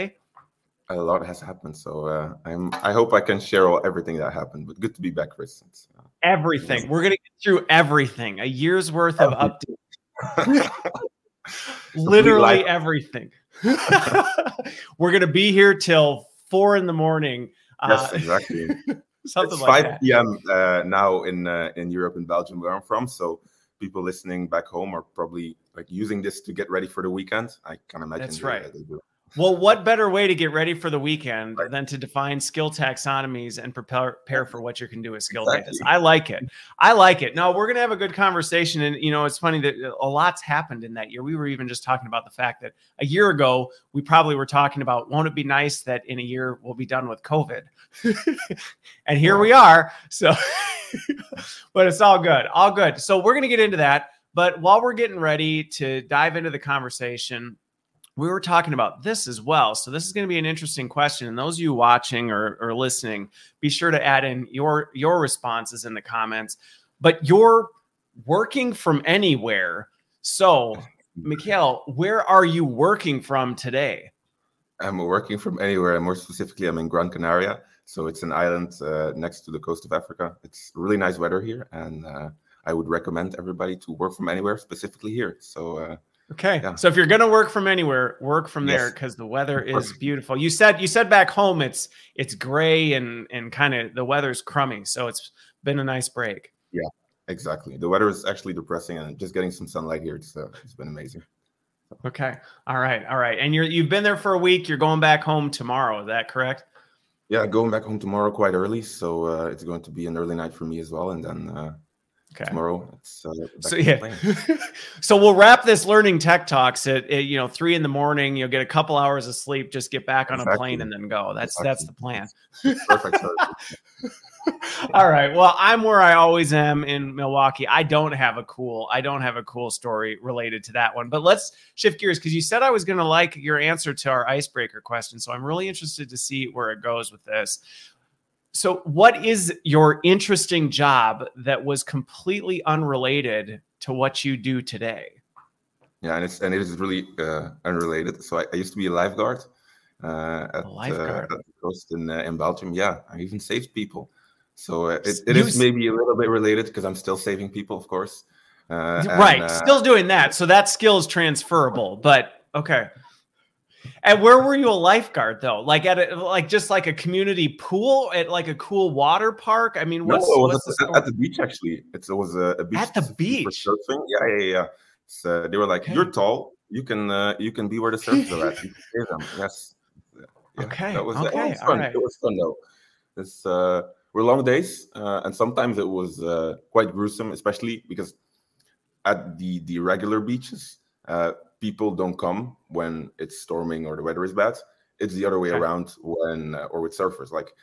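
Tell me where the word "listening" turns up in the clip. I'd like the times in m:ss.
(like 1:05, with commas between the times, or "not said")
0:24, 1:02.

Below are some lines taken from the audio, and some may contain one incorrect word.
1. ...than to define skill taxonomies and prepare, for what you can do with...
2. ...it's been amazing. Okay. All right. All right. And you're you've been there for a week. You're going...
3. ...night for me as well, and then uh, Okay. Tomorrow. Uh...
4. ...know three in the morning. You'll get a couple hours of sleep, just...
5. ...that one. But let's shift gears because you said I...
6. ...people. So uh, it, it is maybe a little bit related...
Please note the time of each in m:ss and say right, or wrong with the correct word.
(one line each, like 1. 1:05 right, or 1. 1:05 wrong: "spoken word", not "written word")
1. 0:31 right
2. 1:40 right
3. 1:50 right
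4. 1:57 right
5. 2:10 right
6. 2:33 right.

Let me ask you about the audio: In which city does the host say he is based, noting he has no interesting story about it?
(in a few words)
Milwaukee.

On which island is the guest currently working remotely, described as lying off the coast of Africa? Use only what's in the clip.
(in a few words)
Gran Canaria.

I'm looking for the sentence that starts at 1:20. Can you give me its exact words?
It's really nice weather here, and uh, I would recommend everybody to work from anywhere, specifically here.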